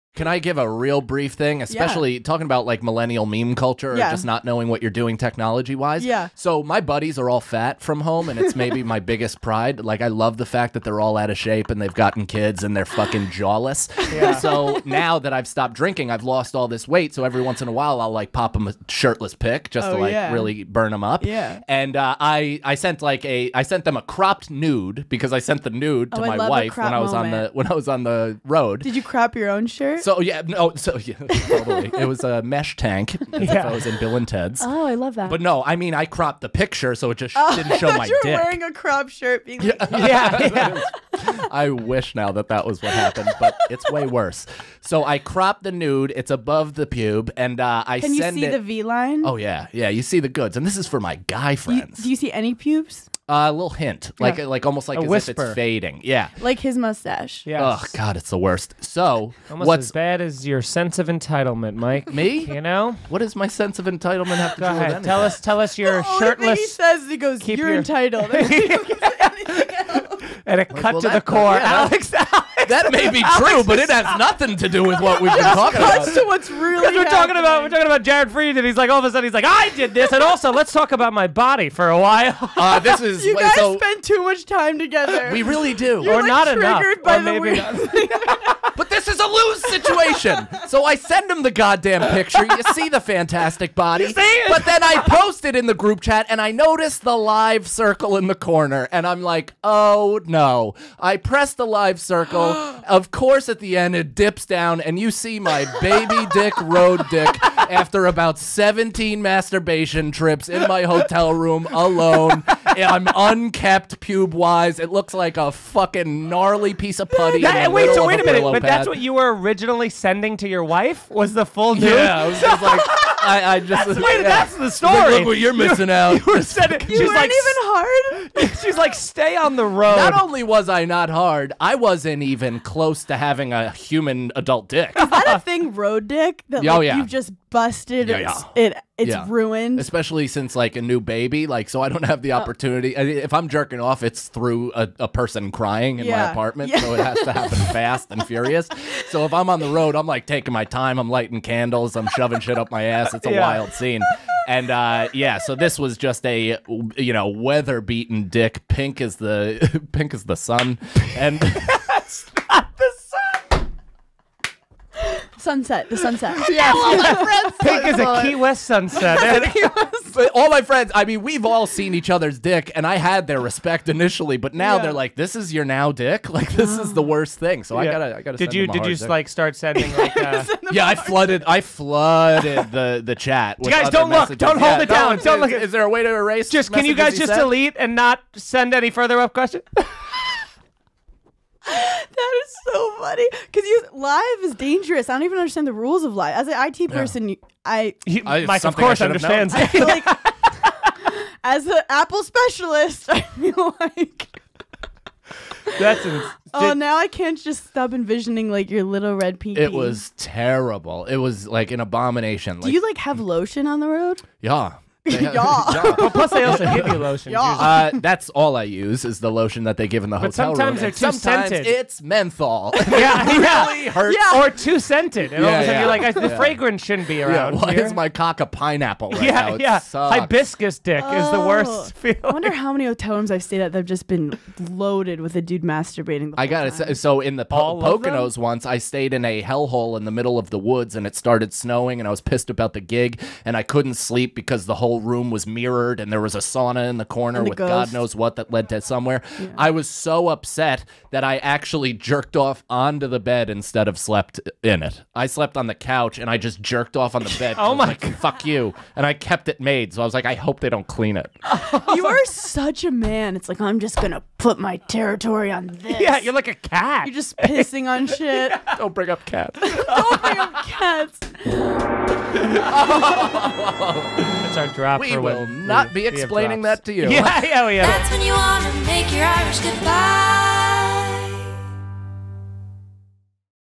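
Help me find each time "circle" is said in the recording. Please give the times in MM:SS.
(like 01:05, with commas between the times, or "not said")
01:37, 01:41.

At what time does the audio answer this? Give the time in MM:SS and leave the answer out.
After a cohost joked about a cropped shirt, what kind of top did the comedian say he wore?
00:32.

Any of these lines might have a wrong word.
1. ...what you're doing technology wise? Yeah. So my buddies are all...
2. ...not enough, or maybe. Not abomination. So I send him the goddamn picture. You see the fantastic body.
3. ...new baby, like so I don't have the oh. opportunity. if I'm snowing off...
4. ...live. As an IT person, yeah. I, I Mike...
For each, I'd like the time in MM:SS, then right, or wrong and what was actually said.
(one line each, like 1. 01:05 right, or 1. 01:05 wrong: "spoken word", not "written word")
1. 00:04 right
2. 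01:26 wrong: "situation", not "abomination"
3. 02:20 wrong: "jerking", not "snowing"
4. 03:16 right.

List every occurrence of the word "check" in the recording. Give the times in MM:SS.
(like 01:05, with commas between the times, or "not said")
not said.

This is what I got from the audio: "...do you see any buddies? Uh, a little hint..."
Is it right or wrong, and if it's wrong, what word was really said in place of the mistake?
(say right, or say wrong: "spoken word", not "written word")
wrong: "pubes", not "buddies".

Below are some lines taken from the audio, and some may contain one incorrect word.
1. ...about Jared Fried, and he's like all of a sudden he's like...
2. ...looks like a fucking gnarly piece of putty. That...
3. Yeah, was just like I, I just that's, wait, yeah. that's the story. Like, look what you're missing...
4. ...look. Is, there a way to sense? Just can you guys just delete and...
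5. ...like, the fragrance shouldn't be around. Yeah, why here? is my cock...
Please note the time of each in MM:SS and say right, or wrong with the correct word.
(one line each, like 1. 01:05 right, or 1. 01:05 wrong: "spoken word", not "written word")
1. 01:17 right
2. 01:54 right
3. 02:01 right
4. 03:05 wrong: "erase", not "sense"
5. 03:45 right.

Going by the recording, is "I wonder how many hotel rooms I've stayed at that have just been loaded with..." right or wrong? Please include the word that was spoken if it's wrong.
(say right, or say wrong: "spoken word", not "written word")
right.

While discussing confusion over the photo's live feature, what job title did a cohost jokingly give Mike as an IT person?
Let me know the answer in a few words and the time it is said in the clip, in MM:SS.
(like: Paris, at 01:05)
Apple specialist, at 03:21.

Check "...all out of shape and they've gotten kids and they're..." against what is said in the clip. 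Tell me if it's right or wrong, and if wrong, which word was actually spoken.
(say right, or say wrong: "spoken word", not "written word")
right.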